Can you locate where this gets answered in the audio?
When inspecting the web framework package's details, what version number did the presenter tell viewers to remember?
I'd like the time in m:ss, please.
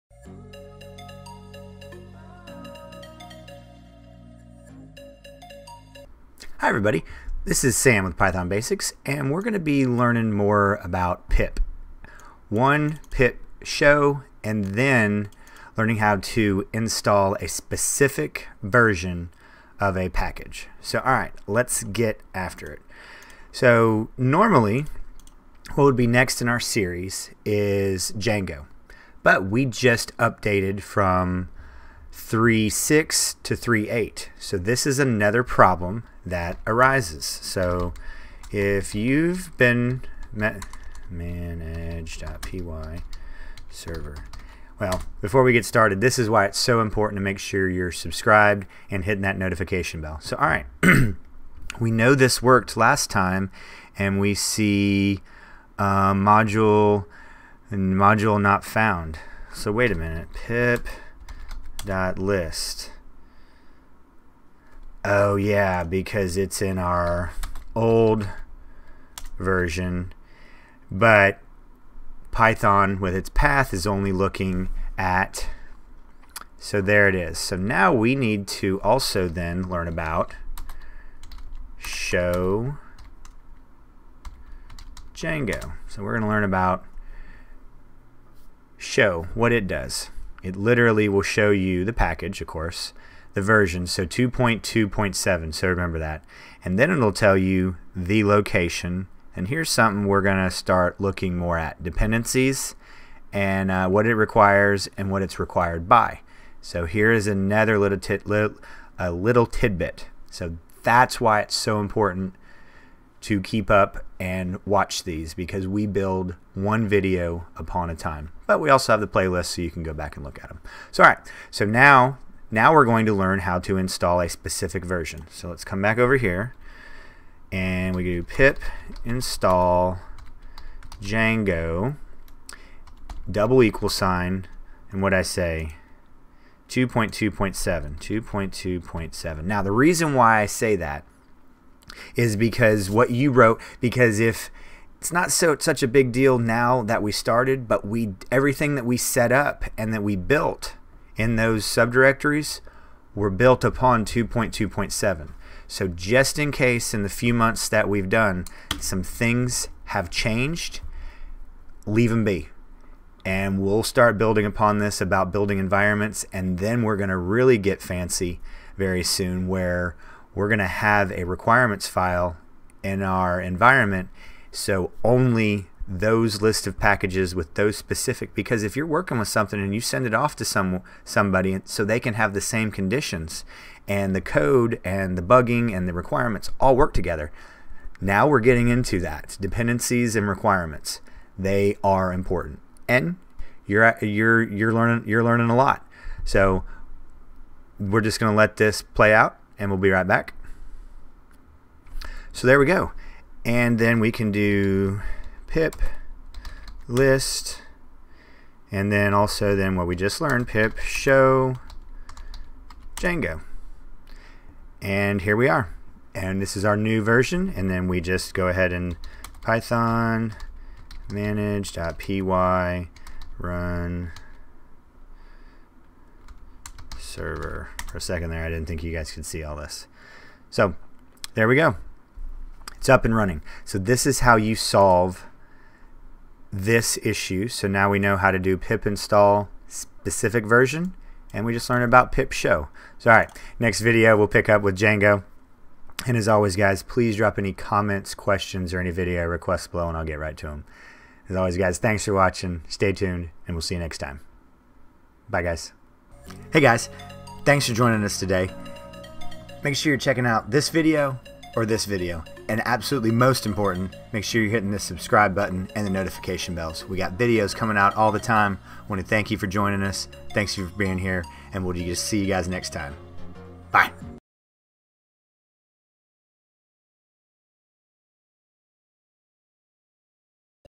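1:34.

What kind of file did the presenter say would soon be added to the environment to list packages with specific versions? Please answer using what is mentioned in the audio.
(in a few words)
requirements file.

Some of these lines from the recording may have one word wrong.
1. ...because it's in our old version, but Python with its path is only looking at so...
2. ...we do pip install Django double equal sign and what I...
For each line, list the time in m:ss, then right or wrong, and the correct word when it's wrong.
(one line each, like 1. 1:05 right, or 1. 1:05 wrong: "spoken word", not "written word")
1. 1:05 right
2. 2:07 right.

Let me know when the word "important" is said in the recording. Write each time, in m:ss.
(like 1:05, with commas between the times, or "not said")
0:46, 1:51, 3:12, 4:23.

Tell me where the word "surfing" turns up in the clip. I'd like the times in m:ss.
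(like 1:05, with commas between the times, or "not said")
not said.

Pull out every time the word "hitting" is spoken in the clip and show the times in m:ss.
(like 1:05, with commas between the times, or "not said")
0:49, 4:24.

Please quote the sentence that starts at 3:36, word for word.
And this is our new version and then we just go ahead and python manage.py run server.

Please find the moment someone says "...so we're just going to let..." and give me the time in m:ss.
3:16.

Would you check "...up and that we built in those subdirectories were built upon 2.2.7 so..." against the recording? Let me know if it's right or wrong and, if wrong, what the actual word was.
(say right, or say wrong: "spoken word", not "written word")
right.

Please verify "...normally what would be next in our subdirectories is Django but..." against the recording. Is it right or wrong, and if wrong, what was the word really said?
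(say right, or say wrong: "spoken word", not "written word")
wrong: "series", not "subdirectories".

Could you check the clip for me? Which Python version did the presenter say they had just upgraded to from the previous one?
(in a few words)
3.8.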